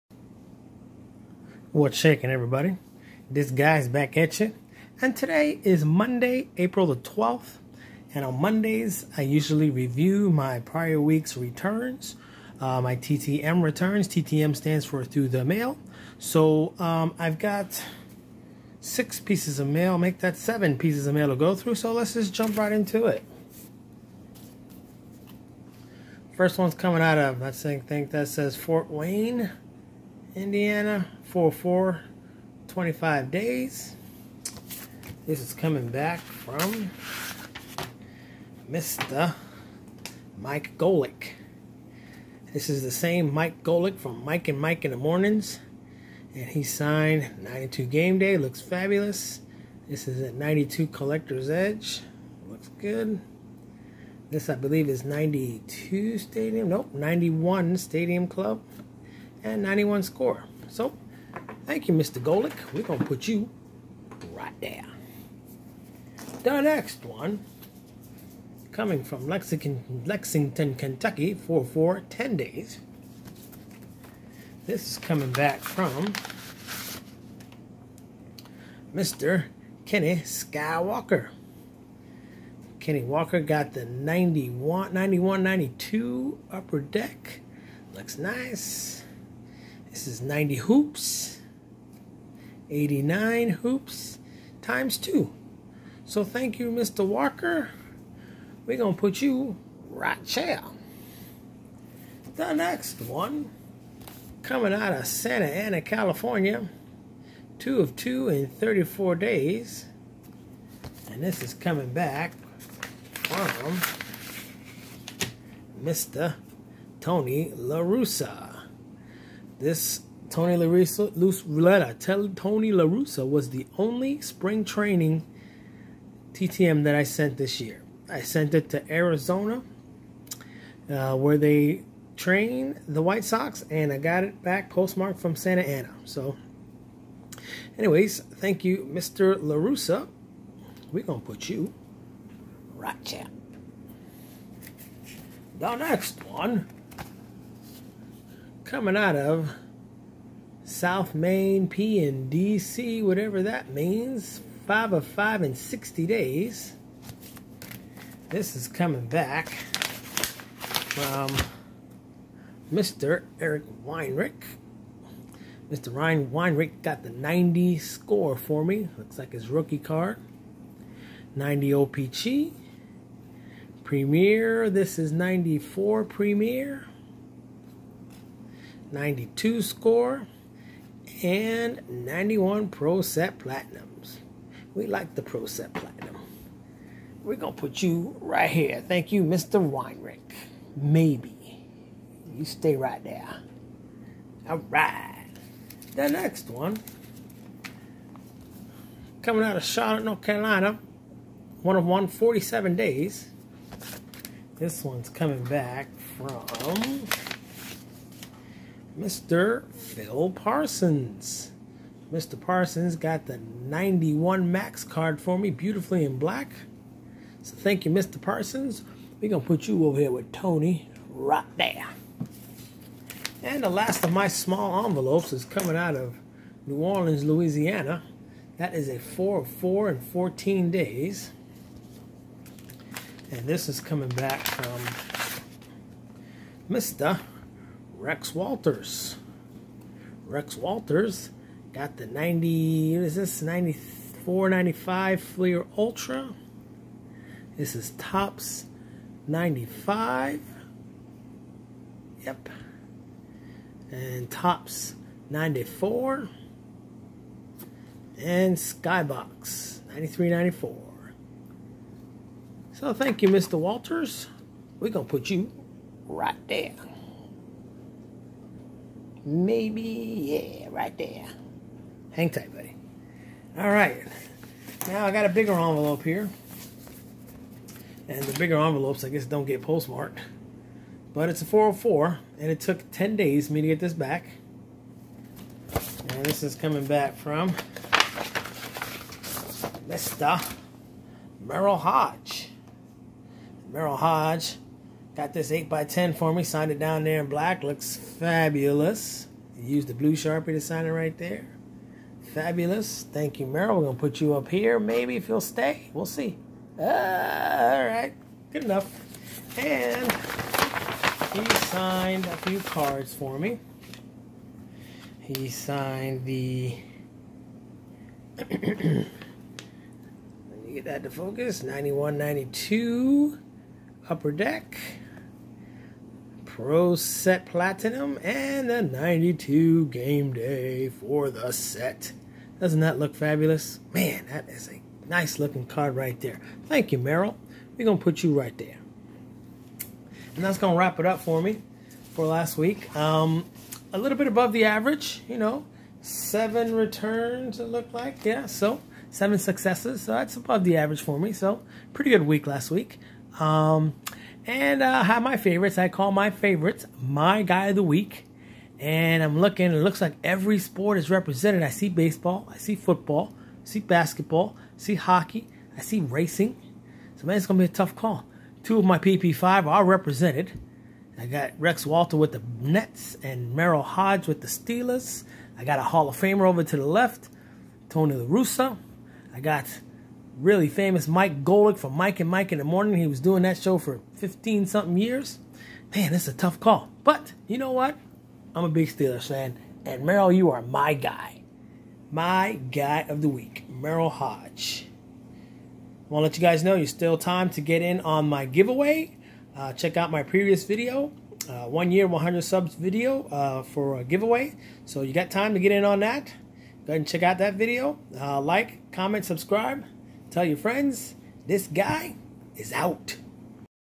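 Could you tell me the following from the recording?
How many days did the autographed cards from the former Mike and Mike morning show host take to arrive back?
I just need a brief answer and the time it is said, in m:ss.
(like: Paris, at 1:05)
25, at 0:32.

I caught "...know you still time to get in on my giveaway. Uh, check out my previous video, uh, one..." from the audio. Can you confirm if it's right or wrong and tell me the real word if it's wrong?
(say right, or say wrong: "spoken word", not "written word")
right.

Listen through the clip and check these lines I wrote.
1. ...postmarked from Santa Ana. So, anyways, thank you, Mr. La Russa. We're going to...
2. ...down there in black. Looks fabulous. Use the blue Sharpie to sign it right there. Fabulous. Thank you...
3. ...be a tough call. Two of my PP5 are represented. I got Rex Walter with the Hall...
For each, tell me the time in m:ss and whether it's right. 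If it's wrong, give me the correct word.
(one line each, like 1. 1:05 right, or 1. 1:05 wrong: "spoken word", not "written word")
1. 2:14 right
2. 4:56 right
3. 6:07 wrong: "Nets", not "Hall".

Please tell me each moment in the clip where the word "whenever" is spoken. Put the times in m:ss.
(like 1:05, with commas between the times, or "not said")
not said.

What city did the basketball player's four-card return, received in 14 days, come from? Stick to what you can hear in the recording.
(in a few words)
New Orleans.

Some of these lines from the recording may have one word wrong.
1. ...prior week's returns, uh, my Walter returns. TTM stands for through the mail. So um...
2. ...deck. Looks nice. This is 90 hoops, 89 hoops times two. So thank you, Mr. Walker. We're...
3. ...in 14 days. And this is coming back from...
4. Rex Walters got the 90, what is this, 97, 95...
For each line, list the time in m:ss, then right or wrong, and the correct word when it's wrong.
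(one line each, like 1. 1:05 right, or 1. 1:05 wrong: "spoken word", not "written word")
1. 0:10 wrong: "TTM", not "Walter"
2. 1:26 right
3. 3:49 right
4. 4:00 wrong: "94", not "97".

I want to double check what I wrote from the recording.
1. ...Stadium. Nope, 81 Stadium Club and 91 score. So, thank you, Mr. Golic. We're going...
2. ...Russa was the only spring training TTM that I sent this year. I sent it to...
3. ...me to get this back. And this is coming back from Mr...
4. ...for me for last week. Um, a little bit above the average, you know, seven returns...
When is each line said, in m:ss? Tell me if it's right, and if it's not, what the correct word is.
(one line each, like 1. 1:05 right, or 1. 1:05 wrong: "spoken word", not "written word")
1. 0:56 wrong: "91", not "81"
2. 2:02 right
3. 4:43 right
4. 5:41 right.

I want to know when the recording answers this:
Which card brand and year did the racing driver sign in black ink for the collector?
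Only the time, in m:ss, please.
3:33.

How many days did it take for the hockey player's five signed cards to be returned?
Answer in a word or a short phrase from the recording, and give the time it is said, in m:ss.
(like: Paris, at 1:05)
60, at 2:35.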